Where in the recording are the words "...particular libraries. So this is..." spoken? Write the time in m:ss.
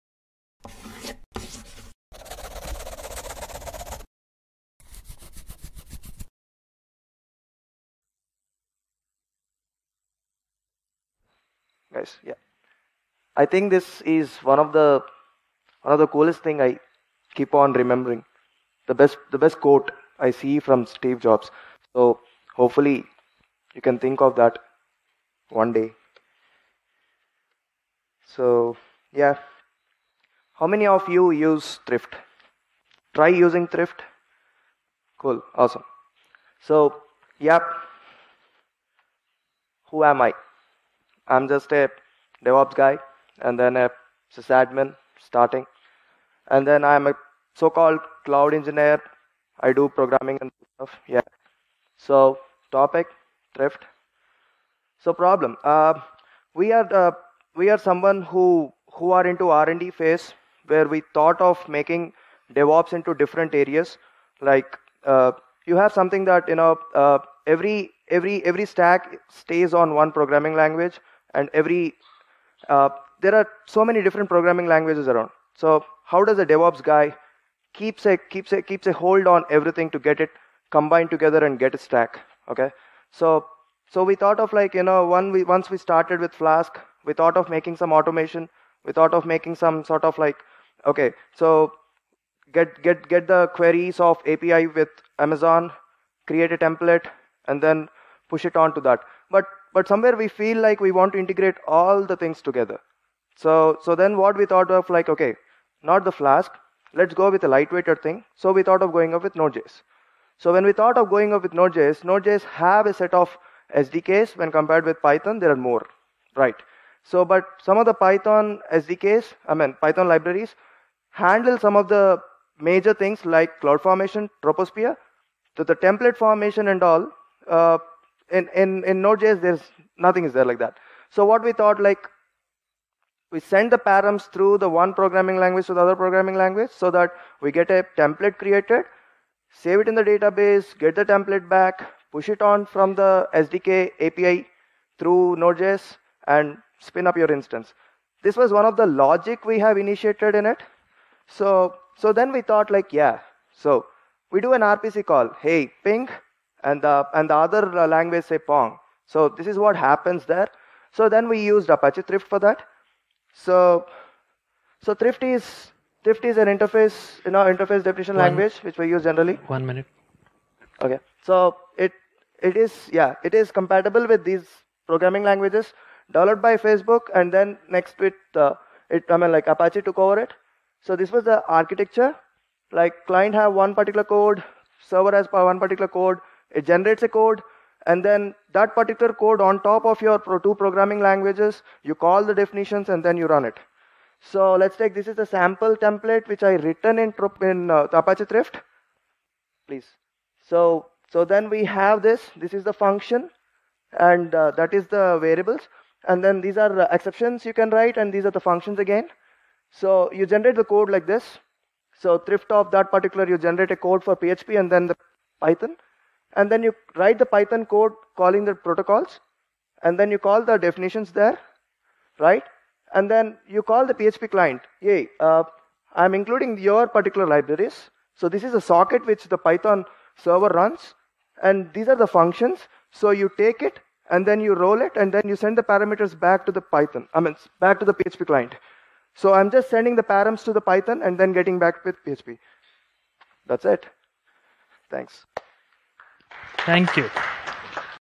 3:46.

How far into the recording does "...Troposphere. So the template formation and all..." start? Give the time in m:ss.
2:04.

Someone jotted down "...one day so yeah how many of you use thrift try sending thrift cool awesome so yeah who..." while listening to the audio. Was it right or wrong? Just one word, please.
wrong.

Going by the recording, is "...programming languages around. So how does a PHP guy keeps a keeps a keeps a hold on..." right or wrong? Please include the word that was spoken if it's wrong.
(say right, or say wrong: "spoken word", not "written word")
wrong: "DevOps", not "PHP".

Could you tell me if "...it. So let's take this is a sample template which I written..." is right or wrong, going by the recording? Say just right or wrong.
right.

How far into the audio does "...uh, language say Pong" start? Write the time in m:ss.
2:37.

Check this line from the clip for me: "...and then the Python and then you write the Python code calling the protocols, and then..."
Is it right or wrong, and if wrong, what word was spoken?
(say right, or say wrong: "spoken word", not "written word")
right.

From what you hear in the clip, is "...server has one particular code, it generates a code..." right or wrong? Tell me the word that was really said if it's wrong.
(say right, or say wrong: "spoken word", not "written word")
right.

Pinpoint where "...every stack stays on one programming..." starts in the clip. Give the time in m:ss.
1:08.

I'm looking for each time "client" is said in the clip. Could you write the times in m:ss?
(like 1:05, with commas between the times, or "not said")
3:03, 3:44, 3:58.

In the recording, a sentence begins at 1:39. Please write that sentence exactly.
But but somewhere we feel like we want to integrate all the things together.